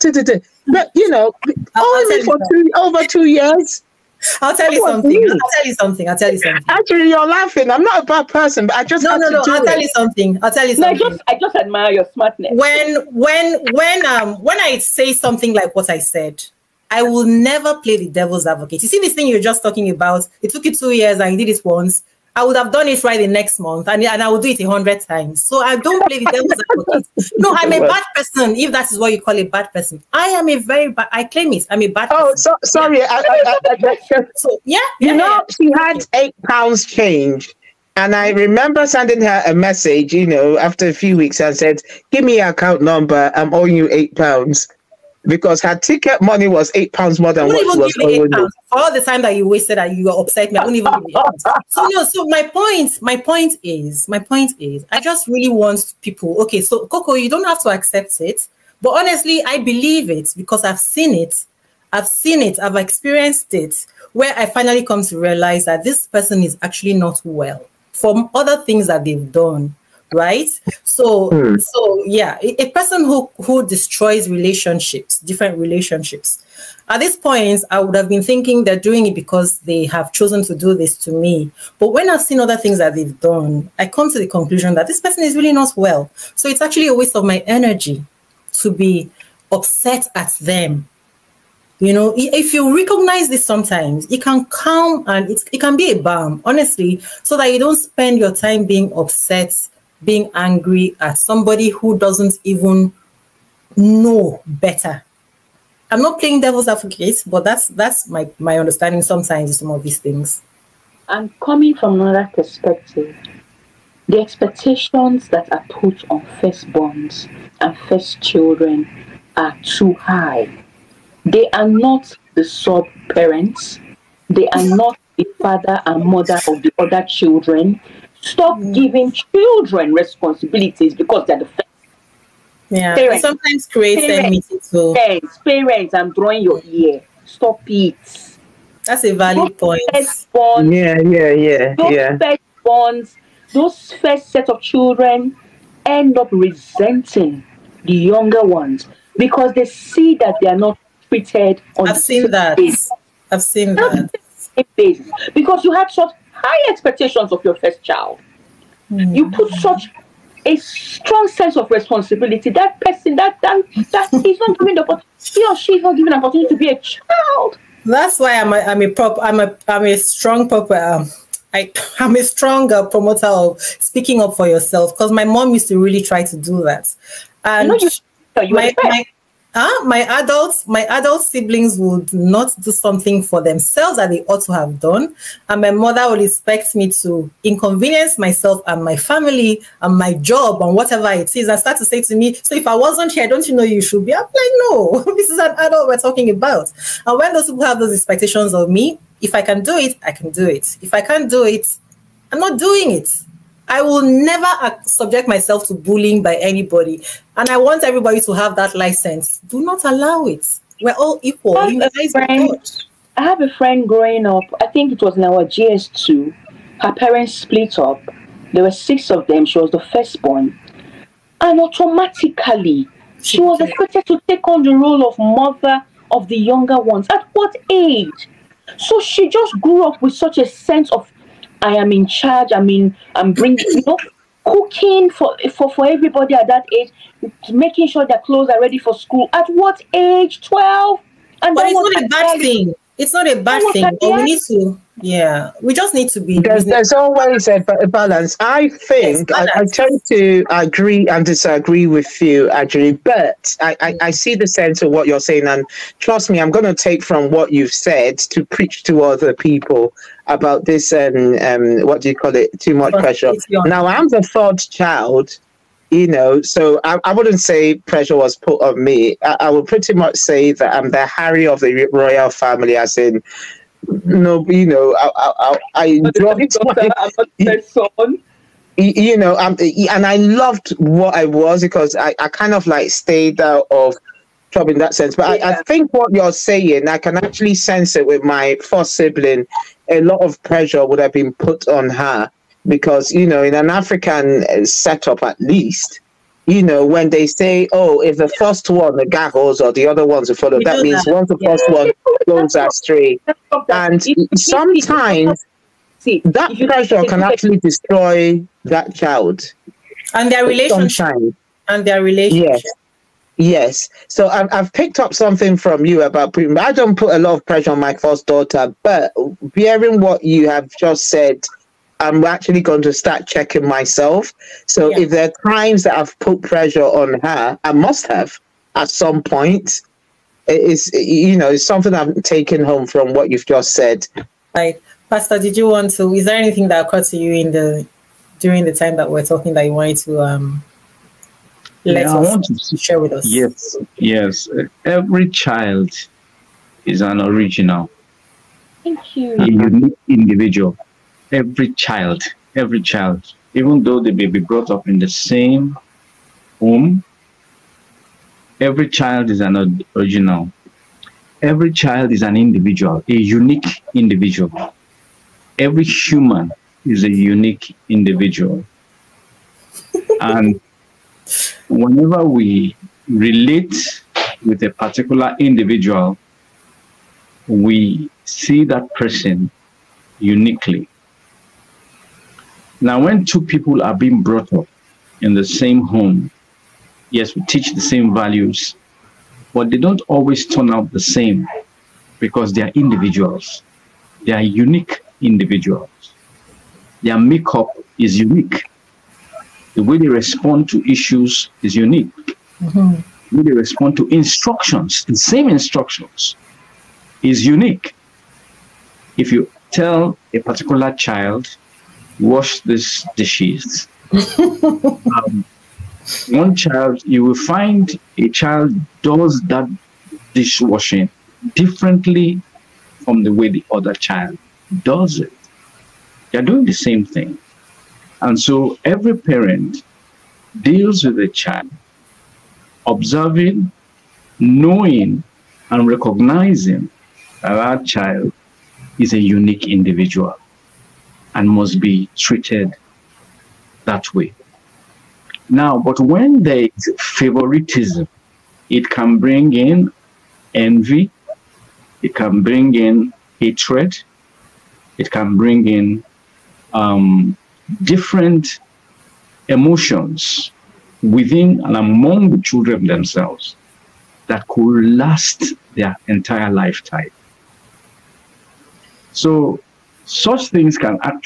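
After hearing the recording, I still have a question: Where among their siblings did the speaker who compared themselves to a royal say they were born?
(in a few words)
third child.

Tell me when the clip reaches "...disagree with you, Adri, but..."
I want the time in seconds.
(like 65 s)
251 s.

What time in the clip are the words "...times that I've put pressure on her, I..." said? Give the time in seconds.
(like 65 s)
325 s.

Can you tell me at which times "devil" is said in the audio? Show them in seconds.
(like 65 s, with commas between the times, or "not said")
18 s, 26 s, 106 s.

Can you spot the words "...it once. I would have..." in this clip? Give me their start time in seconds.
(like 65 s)
21 s.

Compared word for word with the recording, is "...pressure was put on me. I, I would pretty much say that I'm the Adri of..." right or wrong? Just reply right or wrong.
wrong.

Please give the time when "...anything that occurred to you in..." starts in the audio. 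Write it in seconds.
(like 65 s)
336 s.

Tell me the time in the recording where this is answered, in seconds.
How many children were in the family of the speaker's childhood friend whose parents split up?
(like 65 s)
218 s.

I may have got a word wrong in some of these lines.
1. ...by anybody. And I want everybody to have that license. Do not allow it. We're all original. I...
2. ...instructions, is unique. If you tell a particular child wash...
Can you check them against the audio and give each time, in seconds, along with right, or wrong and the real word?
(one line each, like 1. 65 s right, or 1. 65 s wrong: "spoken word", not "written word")
1. 206 s wrong: "equal", not "original"
2. 405 s right.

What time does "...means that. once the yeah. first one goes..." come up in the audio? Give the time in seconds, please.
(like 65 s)
300 s.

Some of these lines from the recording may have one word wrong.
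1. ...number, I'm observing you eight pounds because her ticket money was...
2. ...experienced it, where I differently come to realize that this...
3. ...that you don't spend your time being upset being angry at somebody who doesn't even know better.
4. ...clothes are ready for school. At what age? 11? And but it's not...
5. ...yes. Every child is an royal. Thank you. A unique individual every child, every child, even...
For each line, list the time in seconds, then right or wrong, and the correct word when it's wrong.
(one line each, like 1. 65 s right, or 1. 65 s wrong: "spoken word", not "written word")
1. 42 s wrong: "owing", not "observing"
2. 62 s wrong: "finally", not "differently"
3. 97 s right
4. 238 s wrong: "12", not "11"
5. 343 s wrong: "original", not "royal".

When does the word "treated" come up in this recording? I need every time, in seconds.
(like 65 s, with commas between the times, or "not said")
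151 s, 442 s.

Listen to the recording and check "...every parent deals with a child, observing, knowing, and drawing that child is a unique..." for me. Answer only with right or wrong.
wrong.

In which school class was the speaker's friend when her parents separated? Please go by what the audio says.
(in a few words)
JS2.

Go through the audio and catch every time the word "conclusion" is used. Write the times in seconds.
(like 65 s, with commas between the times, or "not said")
84 s.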